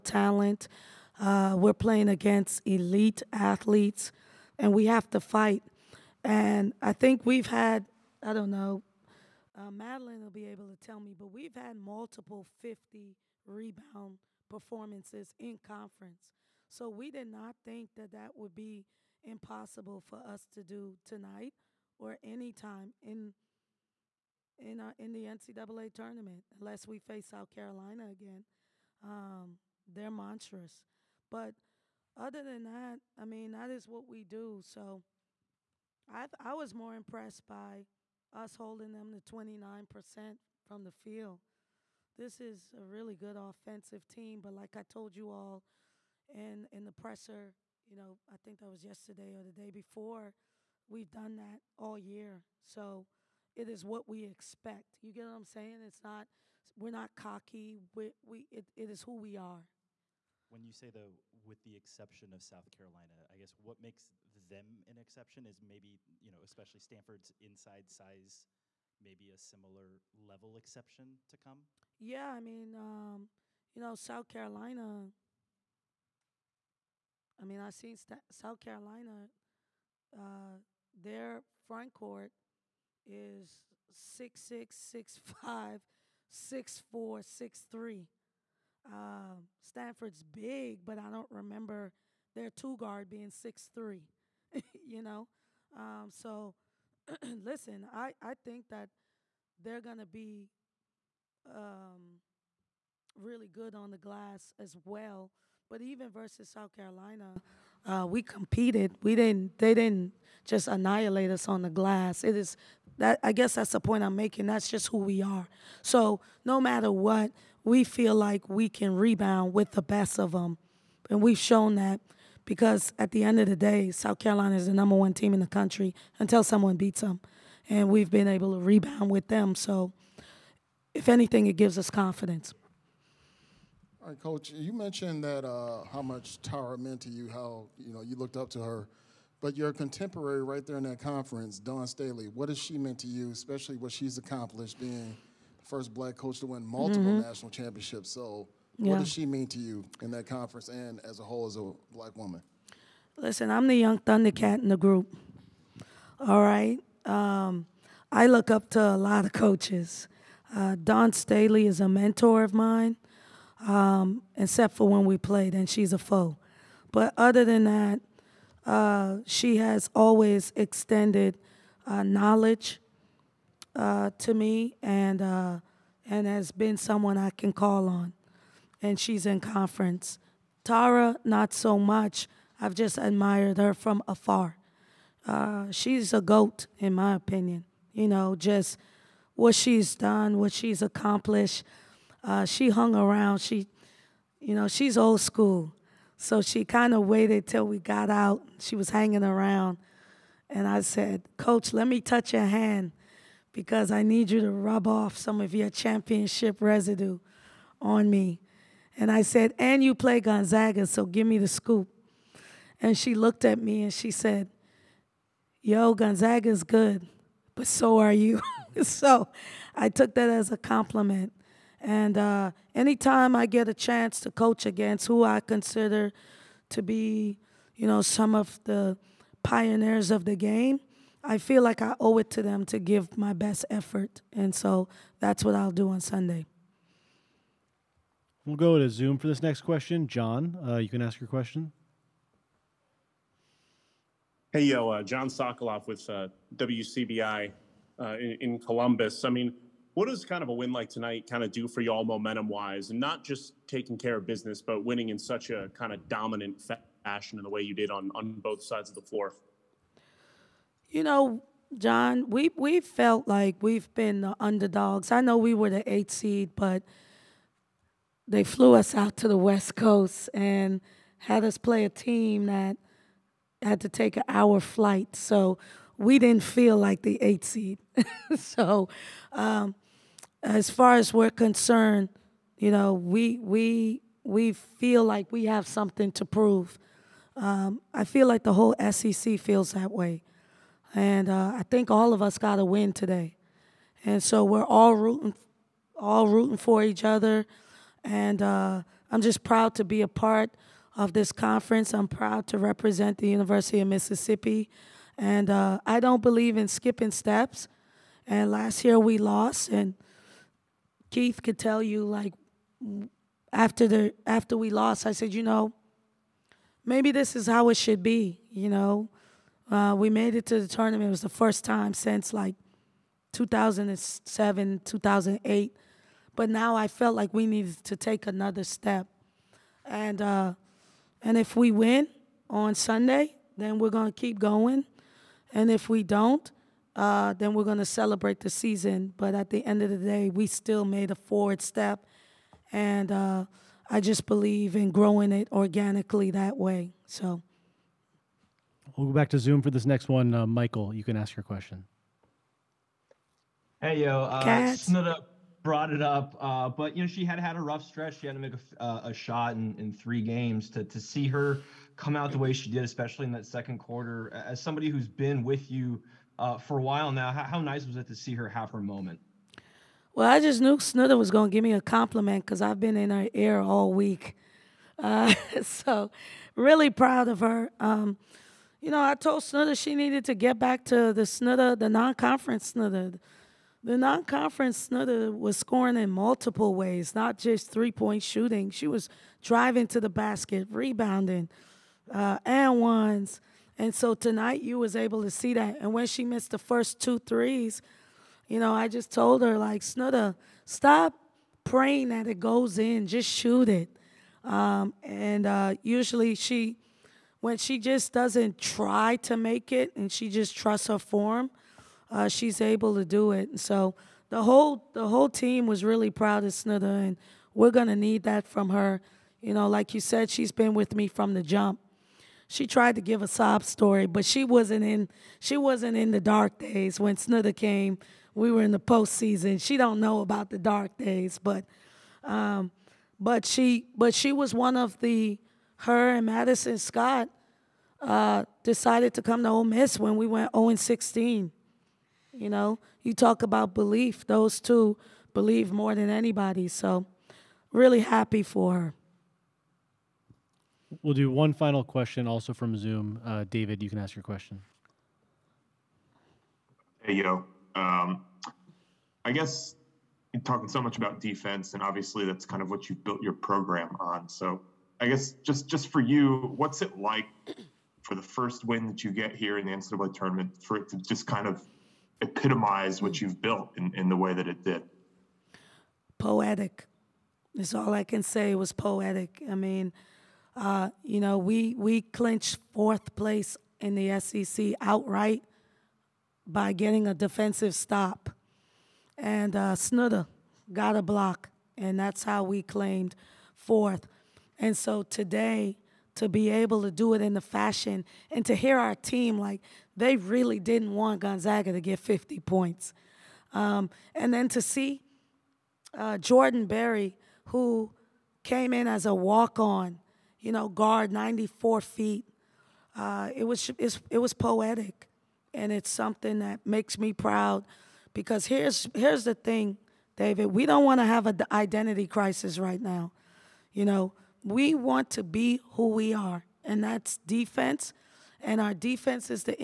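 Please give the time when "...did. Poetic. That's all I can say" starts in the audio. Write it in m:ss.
7:54.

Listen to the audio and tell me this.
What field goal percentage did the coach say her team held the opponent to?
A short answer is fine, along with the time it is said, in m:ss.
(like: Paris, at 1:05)
29%, at 0:39.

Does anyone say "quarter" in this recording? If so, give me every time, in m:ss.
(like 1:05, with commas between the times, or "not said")
6:03.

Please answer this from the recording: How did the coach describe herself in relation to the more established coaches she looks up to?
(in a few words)
the young Thundercat.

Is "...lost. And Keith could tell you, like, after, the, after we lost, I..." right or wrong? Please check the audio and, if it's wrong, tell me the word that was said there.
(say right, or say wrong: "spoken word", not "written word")
right.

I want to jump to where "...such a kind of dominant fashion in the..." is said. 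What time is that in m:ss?
4:15.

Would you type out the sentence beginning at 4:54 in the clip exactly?
And so we're all rooting, all rooting for each other.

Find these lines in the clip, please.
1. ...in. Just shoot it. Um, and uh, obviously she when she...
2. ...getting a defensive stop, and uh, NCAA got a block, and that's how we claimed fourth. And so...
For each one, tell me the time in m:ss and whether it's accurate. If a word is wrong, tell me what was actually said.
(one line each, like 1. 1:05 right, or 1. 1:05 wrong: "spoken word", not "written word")
1. 6:42 wrong: "usually", not "obviously"
2. 8:06 wrong: "Snudda", not "NCAA".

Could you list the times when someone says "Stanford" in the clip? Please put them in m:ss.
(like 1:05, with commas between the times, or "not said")
1:06, 1:29.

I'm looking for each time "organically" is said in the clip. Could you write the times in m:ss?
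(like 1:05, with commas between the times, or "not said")
5:45.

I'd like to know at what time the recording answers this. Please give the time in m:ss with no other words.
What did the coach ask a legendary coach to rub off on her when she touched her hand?
3:25.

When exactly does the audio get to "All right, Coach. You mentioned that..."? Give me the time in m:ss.
2:14.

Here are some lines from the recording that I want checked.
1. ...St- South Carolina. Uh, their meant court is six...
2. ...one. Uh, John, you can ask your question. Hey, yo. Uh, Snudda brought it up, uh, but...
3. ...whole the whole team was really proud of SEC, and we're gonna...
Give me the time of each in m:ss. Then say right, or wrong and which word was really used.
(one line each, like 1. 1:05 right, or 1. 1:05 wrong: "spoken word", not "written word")
1. 1:17 wrong: "front", not "meant"
2. 5:50 wrong: "Michael", not "John"
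3. 6:54 wrong: "Snudda", not "SEC".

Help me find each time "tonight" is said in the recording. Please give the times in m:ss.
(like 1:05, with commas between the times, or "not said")
0:21, 4:10, 6:34.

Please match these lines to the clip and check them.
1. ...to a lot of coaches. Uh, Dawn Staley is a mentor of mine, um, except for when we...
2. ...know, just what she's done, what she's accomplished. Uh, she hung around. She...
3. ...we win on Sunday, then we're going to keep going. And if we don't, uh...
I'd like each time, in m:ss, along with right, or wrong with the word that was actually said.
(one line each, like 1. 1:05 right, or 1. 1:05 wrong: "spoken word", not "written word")
1. 2:38 right
2. 3:08 right
3. 5:31 right.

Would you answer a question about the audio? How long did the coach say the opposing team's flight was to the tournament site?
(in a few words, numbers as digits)
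an hour.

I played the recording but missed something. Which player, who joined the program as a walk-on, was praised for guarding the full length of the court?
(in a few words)
Jordan Berry.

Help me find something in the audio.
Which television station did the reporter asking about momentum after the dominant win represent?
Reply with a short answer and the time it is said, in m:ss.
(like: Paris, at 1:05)
WCBI, at 4:06.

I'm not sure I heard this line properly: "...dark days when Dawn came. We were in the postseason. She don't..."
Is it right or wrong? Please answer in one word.
wrong.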